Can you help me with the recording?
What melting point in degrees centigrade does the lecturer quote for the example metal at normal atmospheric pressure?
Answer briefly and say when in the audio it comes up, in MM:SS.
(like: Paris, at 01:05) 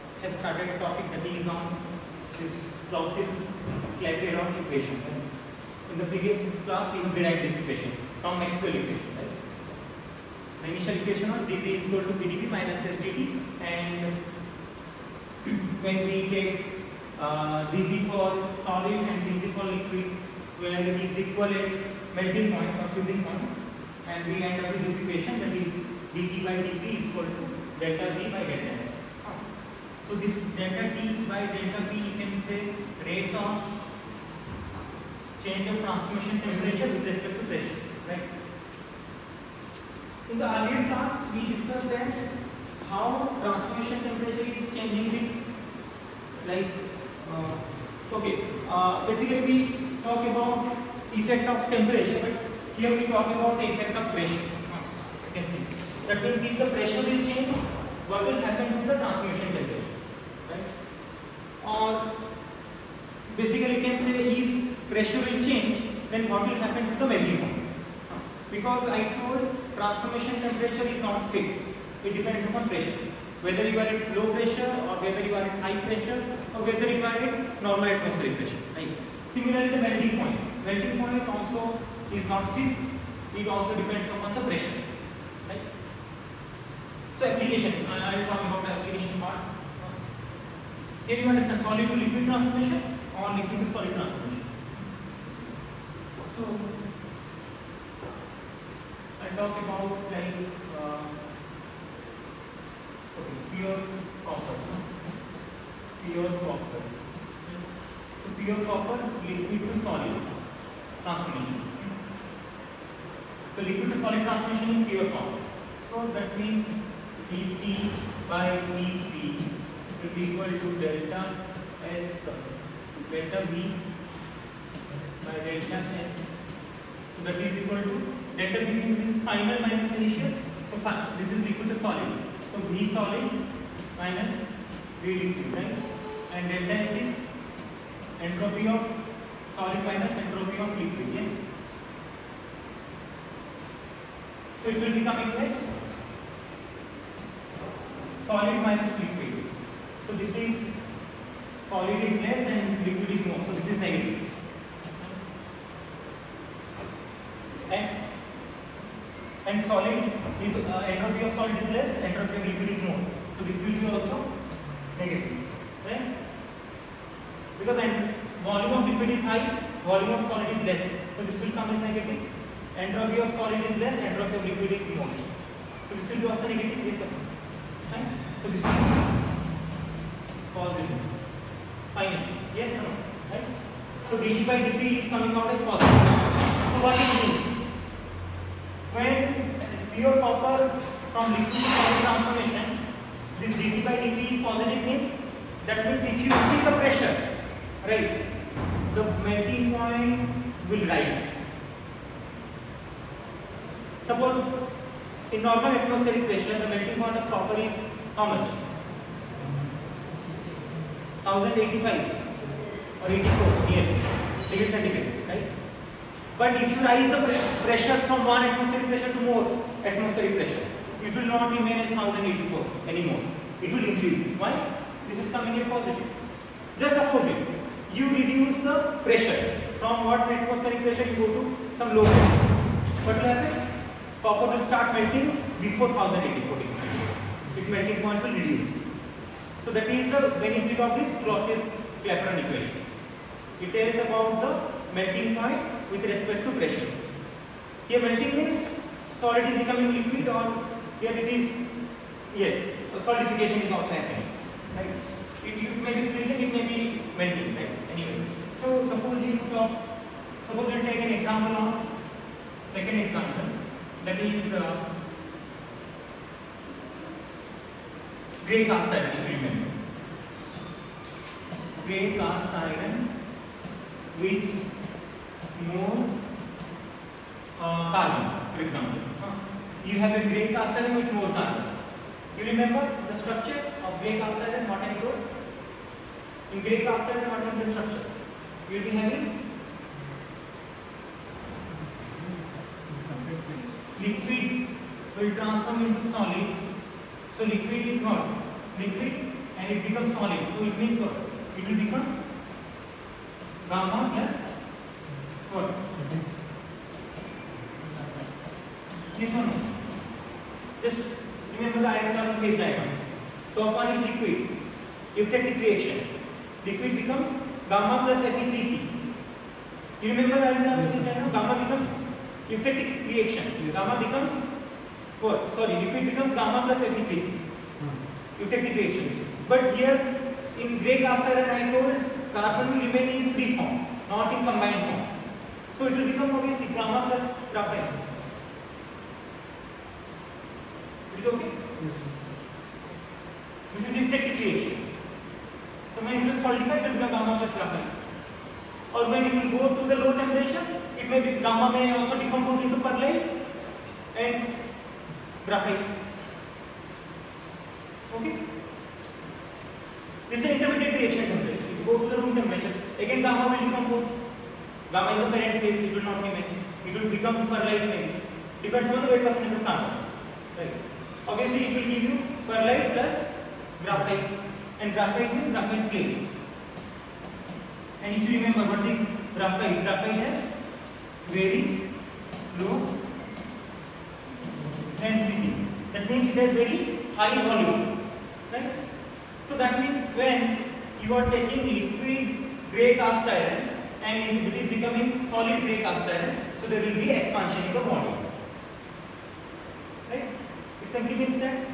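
1084, at 03:33.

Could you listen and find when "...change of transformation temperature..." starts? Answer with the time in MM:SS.
00:35.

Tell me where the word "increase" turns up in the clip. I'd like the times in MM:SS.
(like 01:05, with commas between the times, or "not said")
03:16, 03:43.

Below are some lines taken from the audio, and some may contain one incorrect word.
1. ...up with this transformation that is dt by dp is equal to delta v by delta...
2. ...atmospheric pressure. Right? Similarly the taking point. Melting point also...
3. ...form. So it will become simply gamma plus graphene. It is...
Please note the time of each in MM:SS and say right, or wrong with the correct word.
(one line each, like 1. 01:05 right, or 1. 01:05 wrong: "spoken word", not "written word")
1. 00:24 wrong: "equation", not "transformation"
2. 01:17 wrong: "melting", not "taking"
3. 05:34 wrong: "obviously", not "simply".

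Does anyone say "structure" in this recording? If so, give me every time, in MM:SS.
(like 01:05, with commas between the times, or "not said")
04:43, 04:47.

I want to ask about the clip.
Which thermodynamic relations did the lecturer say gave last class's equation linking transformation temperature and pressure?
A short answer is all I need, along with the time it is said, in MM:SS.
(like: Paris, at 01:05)
Maxwell equation, at 00:08.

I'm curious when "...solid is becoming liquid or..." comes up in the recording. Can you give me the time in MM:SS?
04:09.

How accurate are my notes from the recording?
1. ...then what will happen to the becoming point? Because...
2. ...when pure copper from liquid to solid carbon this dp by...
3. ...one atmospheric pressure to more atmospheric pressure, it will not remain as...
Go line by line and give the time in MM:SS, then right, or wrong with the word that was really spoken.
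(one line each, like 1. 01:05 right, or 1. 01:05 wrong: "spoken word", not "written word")
1. 01:06 wrong: "melting", not "becoming"
2. 03:08 wrong: "transformation", not "carbon"
3. 03:38 right.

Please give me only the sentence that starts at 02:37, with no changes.
And, and solid is uh, entropy of solid is less, entropy of liquid is more.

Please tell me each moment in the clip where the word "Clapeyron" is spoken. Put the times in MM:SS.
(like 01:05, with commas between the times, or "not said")
00:03, 04:01.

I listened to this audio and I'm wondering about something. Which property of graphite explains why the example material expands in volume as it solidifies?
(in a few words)
Very low density.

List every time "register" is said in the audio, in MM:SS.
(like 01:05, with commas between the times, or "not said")
not said.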